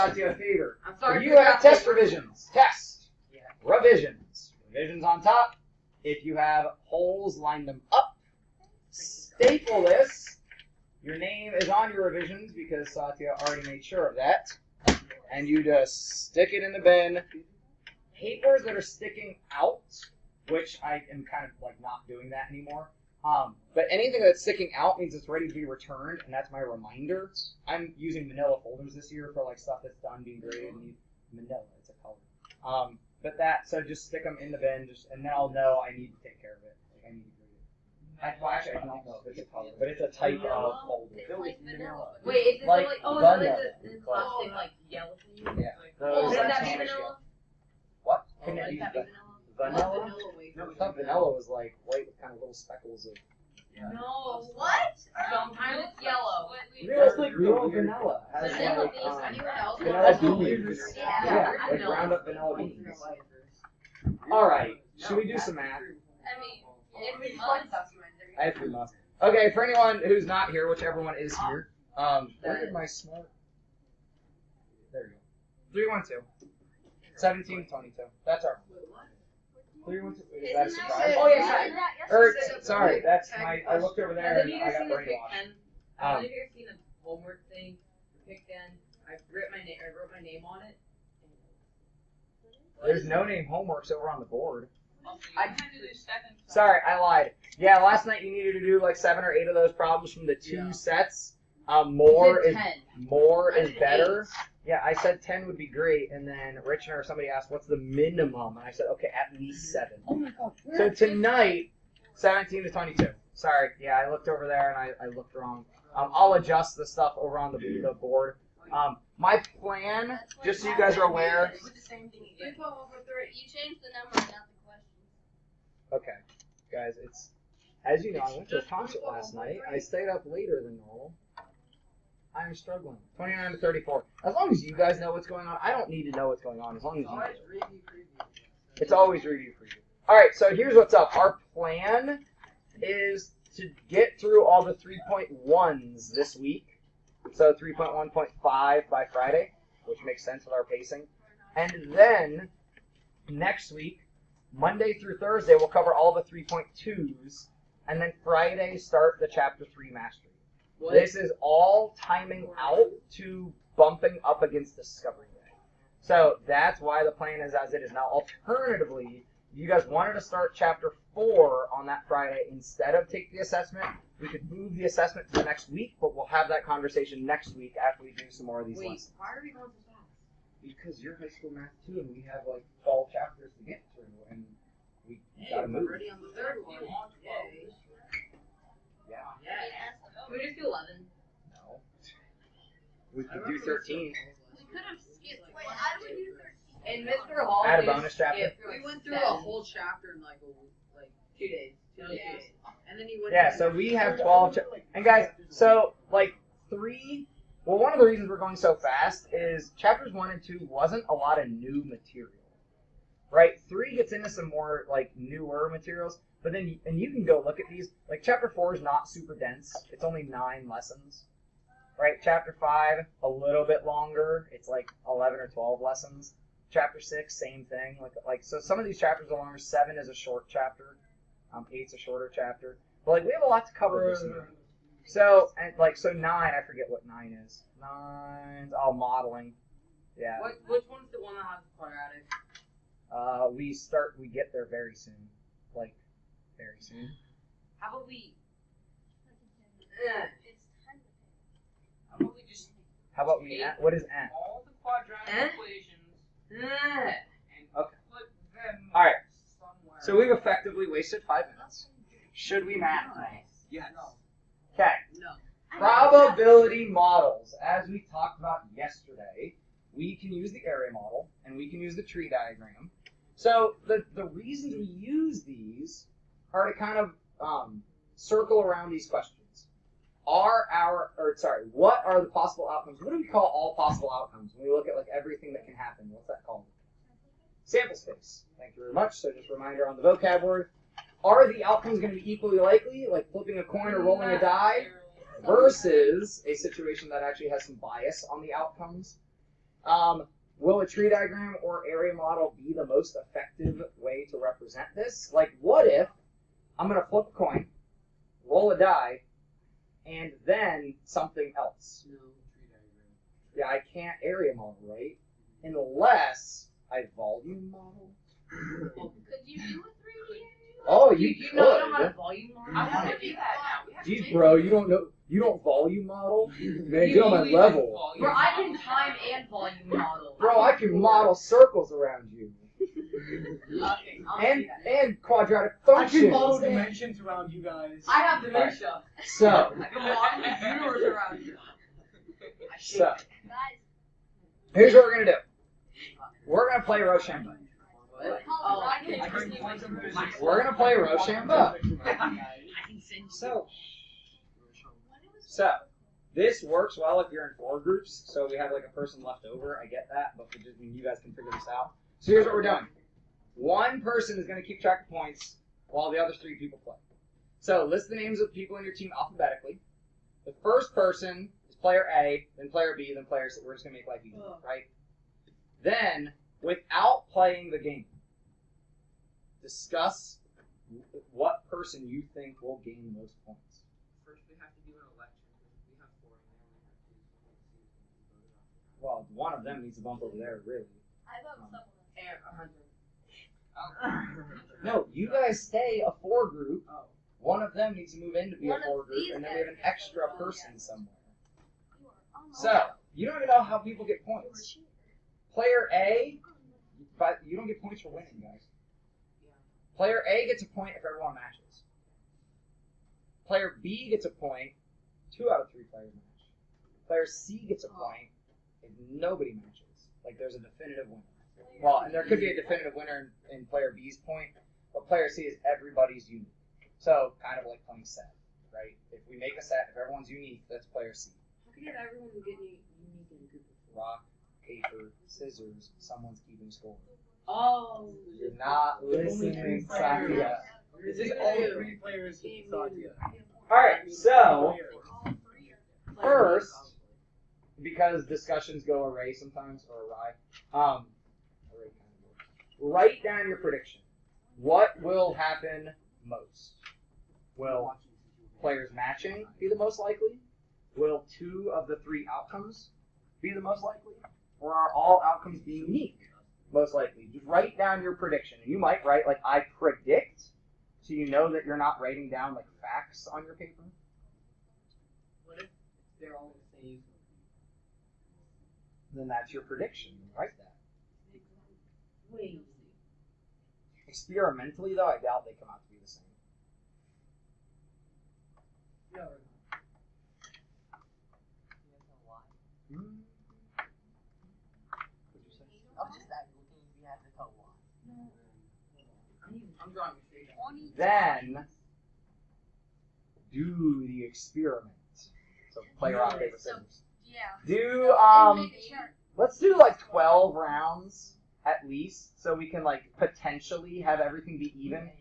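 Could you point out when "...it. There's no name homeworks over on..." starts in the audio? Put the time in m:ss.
1:30.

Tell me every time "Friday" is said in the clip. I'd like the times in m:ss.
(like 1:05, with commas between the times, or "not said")
2:29, 2:38, 2:52.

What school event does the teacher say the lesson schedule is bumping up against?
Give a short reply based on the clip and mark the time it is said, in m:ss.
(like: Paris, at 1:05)
Discovery Day, at 2:44.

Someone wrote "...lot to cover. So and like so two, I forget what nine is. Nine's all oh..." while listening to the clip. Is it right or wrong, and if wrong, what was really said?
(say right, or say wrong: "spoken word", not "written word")
wrong: "nine", not "two".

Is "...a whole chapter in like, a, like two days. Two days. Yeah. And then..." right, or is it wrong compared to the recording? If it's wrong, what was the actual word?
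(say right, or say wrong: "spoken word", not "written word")
right.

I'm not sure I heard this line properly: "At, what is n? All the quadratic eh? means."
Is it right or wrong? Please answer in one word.
wrong.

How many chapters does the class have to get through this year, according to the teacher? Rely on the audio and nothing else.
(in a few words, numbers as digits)
12.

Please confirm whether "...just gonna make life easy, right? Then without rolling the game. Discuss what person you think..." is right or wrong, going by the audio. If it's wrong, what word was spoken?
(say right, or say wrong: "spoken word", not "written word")
wrong: "playing", not "rolling".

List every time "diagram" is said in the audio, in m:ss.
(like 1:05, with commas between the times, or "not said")
4:32, 5:01.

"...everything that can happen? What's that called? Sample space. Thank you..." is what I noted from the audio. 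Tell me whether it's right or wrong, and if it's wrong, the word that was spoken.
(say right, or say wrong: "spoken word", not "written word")
right.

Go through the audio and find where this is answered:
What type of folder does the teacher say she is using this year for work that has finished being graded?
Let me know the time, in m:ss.
0:28.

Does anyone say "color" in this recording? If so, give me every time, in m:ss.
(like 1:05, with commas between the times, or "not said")
0:32, 0:39.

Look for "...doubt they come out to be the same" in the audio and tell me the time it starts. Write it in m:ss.
8:05.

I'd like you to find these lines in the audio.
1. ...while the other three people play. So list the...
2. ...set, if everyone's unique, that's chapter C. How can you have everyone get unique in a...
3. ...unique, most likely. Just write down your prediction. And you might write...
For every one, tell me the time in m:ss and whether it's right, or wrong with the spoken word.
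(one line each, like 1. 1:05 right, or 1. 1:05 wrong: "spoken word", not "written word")
1. 6:05 right
2. 7:09 wrong: "player", not "chapter"
3. 7:45 right.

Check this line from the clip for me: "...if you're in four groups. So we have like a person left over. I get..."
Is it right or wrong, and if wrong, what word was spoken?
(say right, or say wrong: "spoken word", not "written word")
right.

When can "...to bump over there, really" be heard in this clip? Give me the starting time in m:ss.
6:29.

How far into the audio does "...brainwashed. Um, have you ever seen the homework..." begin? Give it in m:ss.
1:24.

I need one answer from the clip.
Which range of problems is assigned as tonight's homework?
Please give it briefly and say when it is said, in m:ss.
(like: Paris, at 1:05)
17 to 22, at 1:52.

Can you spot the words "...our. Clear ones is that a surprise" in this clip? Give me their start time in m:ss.
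1:18.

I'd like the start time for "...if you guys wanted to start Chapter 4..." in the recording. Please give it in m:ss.
2:49.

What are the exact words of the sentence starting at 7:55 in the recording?
What if they're all the same?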